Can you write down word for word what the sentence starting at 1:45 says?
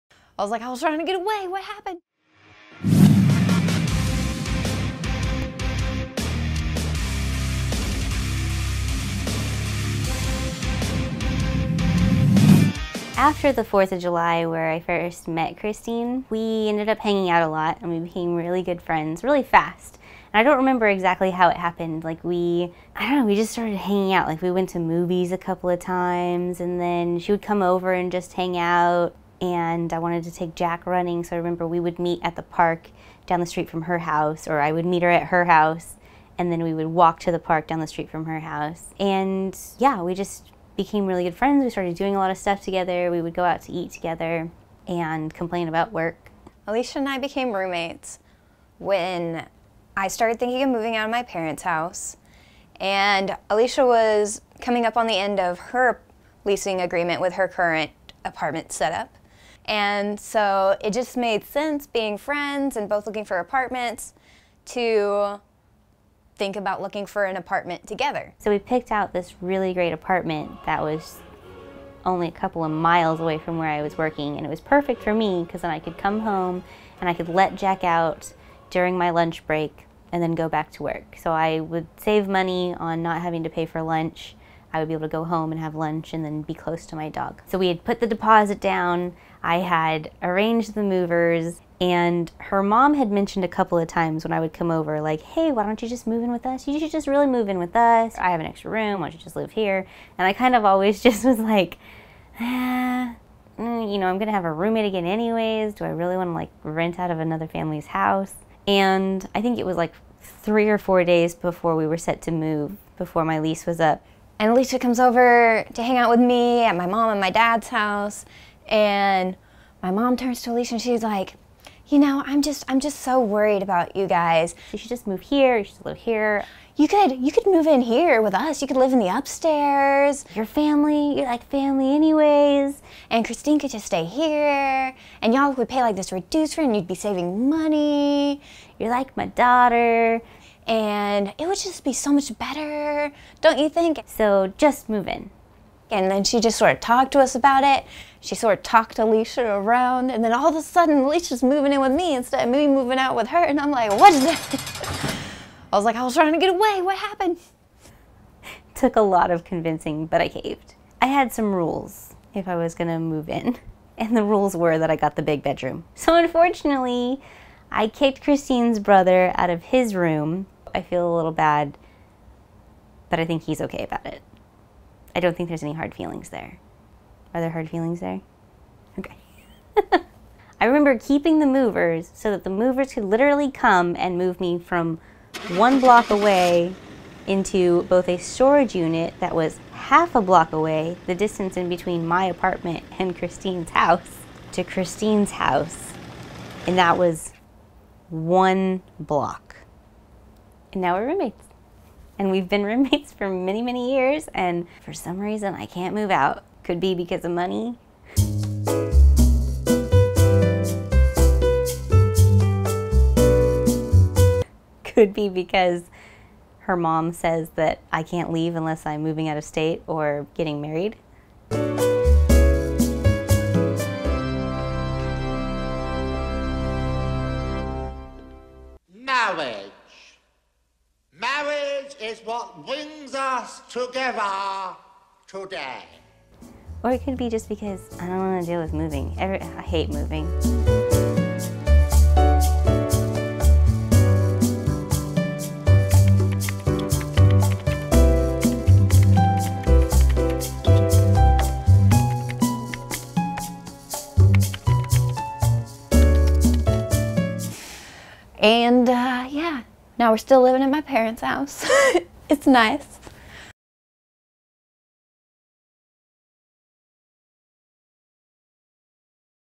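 Do I really wanna like rent out of another family's house?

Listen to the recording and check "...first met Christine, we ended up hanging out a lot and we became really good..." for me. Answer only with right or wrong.
right.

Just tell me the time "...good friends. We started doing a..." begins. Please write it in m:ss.
0:41.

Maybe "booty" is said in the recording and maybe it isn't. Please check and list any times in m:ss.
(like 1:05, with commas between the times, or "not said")
not said.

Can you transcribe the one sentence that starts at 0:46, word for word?
Alicia and I became roommates when I started thinking of moving out of my parents' house.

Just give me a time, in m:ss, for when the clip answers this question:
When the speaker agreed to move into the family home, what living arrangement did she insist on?
2:45.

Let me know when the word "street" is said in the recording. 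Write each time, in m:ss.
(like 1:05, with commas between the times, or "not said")
0:33, 0:37.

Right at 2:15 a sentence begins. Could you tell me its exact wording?
And y'all would pay like this reduced rent and you'd be saving money.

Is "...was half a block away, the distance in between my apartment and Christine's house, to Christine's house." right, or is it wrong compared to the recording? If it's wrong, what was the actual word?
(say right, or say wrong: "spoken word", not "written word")
right.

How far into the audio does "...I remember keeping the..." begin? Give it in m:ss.
3:00.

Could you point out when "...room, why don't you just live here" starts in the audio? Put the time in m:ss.
1:38.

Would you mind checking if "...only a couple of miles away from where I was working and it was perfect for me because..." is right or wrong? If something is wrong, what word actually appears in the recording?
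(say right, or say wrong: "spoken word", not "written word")
right.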